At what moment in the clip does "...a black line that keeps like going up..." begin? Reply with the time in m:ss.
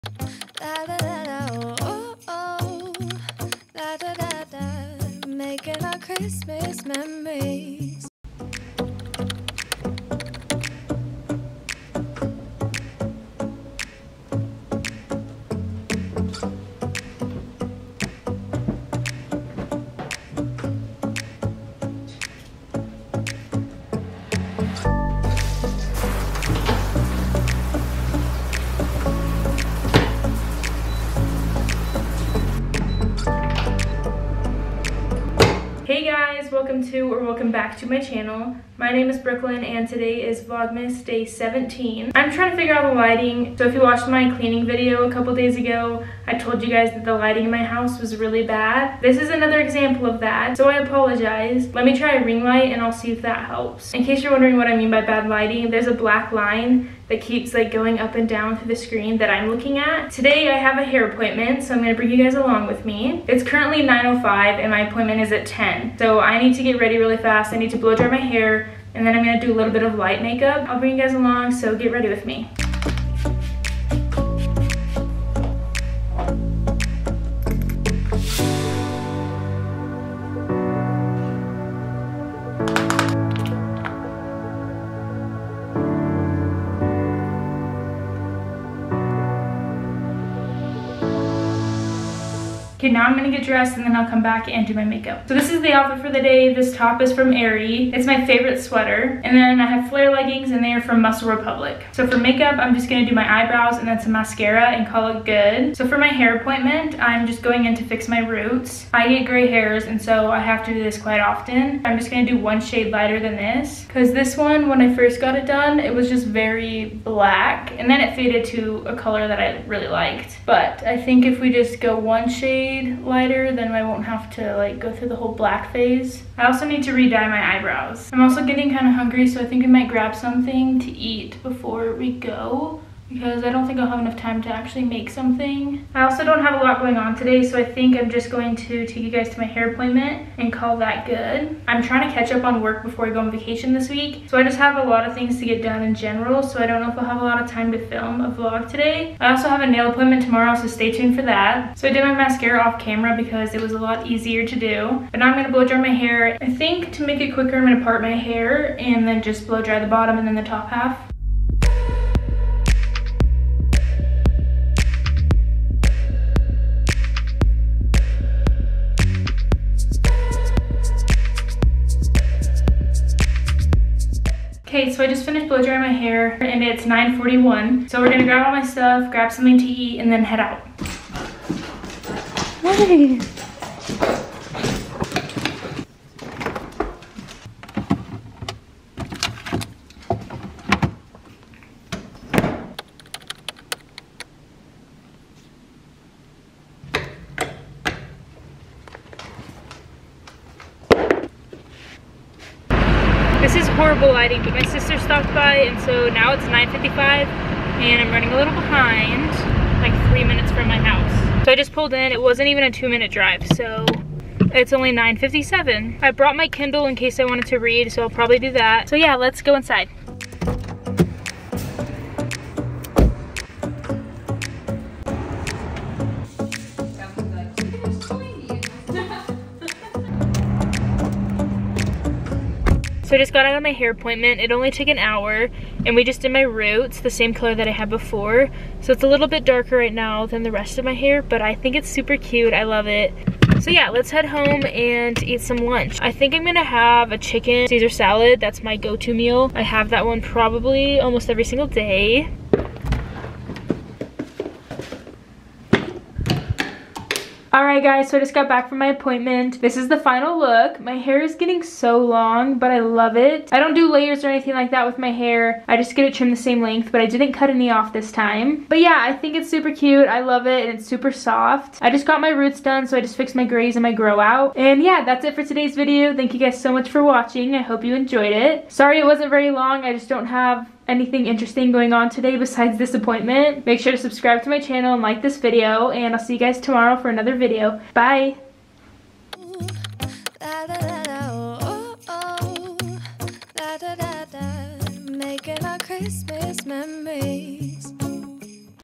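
0:55.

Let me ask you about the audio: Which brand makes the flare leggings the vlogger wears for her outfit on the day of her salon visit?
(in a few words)
Muscle Republic.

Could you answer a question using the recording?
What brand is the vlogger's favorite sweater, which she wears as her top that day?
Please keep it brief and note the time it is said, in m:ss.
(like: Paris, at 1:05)
Aerie, at 1:37.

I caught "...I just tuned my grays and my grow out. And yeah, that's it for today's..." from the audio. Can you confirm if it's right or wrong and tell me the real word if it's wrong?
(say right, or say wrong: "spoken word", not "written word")
wrong: "fixed", not "tuned".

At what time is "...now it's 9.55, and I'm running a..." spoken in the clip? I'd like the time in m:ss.
3:26.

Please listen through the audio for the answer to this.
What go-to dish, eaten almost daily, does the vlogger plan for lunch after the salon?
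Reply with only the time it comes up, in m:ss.
4:07.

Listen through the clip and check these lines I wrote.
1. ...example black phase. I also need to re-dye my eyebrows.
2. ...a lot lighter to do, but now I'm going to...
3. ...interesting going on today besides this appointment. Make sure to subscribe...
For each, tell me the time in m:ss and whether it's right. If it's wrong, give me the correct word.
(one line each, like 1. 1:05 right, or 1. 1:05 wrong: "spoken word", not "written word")
1. 2:05 wrong: "whole", not "example"
2. 2:33 wrong: "easier", not "lighter"
3. 4:41 right.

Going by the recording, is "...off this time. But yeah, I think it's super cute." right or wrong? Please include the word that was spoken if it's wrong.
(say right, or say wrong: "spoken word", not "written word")
right.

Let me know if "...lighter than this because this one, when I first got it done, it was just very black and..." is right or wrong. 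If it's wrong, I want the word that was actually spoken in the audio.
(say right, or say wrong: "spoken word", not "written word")
right.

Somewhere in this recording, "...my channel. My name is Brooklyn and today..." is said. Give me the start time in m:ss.
0:37.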